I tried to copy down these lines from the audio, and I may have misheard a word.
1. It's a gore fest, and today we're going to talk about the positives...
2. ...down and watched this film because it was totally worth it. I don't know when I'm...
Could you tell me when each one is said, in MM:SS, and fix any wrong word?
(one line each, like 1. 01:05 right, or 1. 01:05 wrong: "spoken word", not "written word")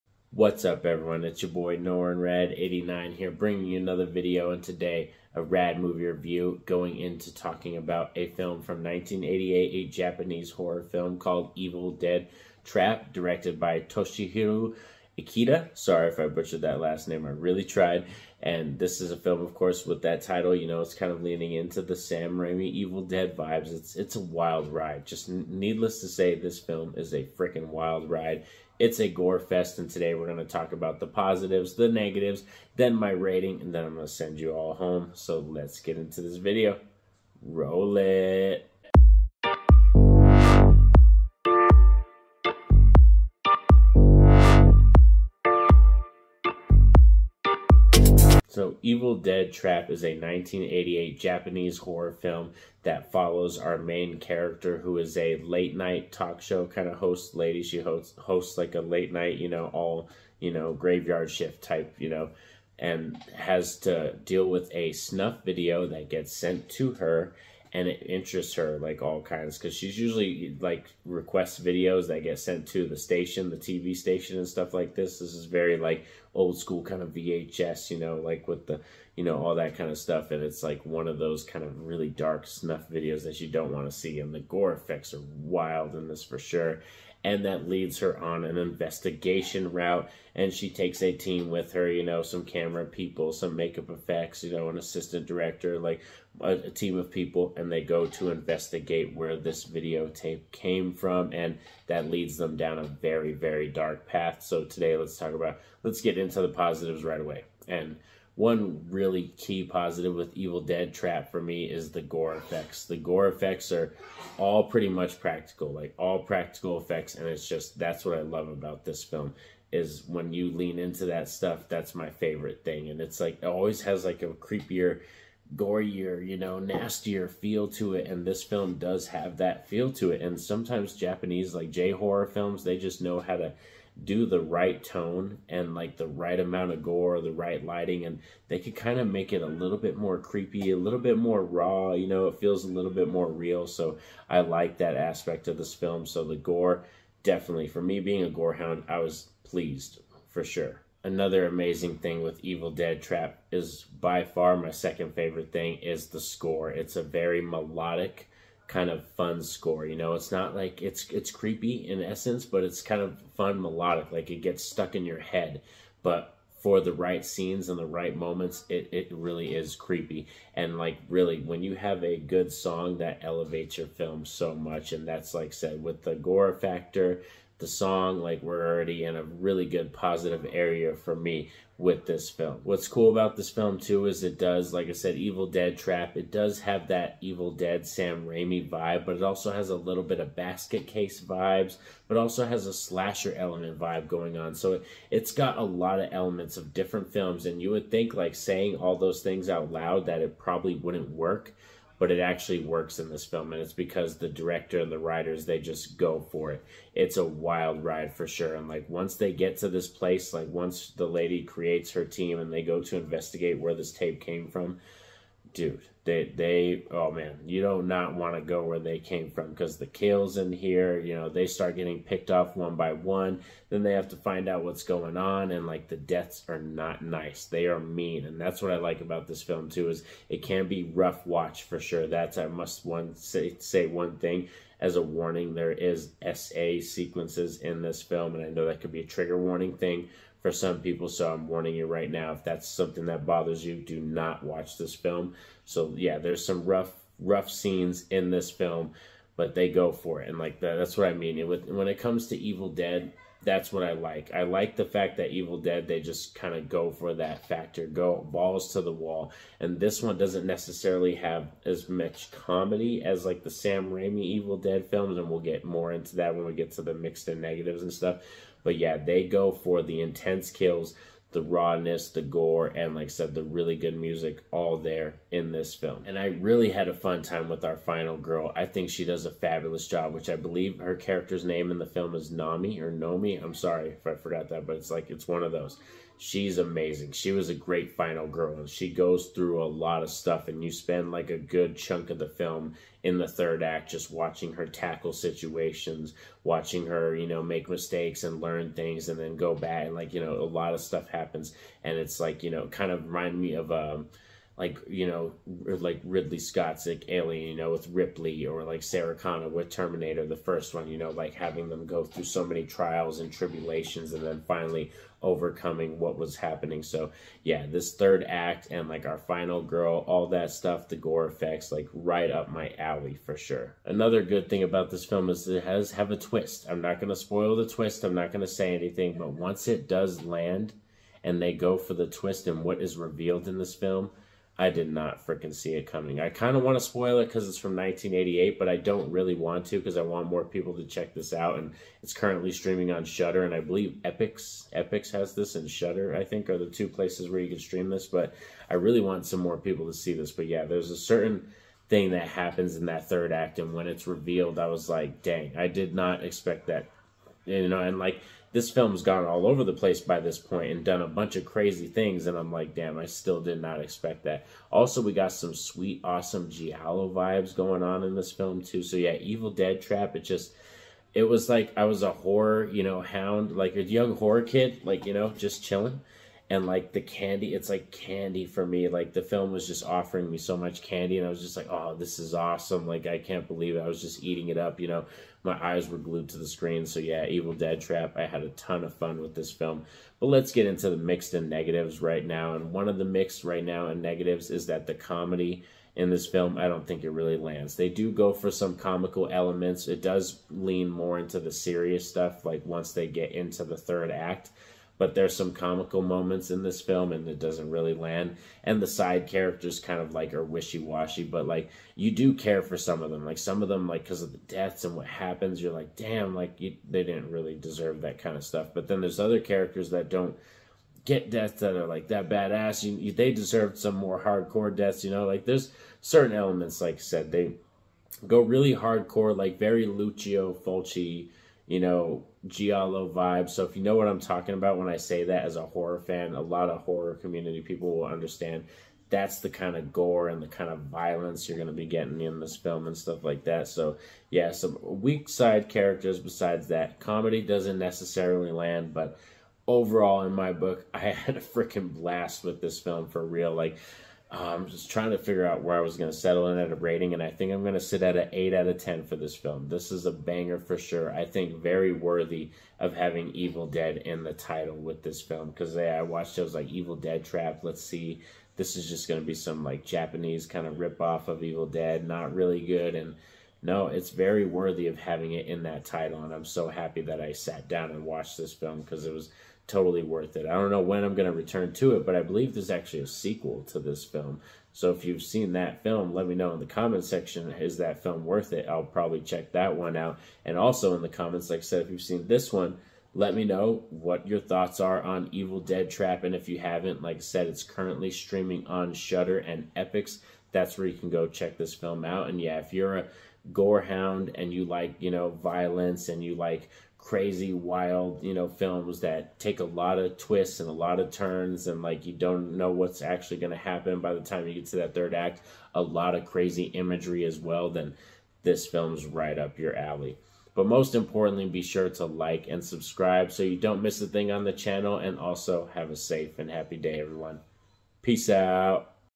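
1. 00:28 right
2. 07:57 right.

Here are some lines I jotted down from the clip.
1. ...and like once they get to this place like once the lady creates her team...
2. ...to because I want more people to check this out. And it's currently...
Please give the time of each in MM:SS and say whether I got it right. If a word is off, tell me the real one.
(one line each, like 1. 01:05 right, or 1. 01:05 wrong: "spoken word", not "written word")
1. 03:28 right
2. 05:39 right.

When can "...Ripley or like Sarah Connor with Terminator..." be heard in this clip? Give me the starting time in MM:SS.
05:07.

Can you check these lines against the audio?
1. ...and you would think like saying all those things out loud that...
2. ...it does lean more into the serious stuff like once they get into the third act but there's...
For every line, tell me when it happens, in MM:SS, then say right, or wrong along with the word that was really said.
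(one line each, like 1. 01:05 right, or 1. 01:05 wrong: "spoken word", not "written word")
1. 03:17 right
2. 06:39 right.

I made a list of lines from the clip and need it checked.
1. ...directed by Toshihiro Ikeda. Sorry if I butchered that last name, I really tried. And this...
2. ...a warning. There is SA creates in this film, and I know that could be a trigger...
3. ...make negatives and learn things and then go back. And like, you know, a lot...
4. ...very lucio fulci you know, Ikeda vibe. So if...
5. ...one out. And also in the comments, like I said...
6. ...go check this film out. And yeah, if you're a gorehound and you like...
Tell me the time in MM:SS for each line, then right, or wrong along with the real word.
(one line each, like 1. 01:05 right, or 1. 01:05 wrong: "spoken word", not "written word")
1. 00:13 right
2. 03:54 wrong: "sequences", not "creates"
3. 04:57 wrong: "mistakes", not "negatives"
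4. 07:09 wrong: "Giallo", not "Ikeda"
5. 08:09 right
6. 08:21 right.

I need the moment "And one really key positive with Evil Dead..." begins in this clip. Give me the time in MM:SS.
01:47.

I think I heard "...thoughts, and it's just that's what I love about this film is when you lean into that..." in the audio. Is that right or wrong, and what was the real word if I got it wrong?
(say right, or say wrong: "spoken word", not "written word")
wrong: "effects", not "thoughts".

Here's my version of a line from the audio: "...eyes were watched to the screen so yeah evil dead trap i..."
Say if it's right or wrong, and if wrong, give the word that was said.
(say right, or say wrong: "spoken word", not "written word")
wrong: "glued", not "watched".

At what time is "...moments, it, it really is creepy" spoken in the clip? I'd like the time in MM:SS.
02:48.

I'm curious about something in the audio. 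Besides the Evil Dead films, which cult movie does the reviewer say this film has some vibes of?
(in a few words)
Basket Case.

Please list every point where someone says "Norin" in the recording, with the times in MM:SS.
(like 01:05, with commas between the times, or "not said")
00:01.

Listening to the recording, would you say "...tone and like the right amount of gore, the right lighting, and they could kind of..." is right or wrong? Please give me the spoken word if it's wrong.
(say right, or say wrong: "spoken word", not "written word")
right.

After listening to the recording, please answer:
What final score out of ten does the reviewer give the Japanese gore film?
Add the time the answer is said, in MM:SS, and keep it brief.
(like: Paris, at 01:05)
8, at 07:38.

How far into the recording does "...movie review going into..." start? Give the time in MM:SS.
00:05.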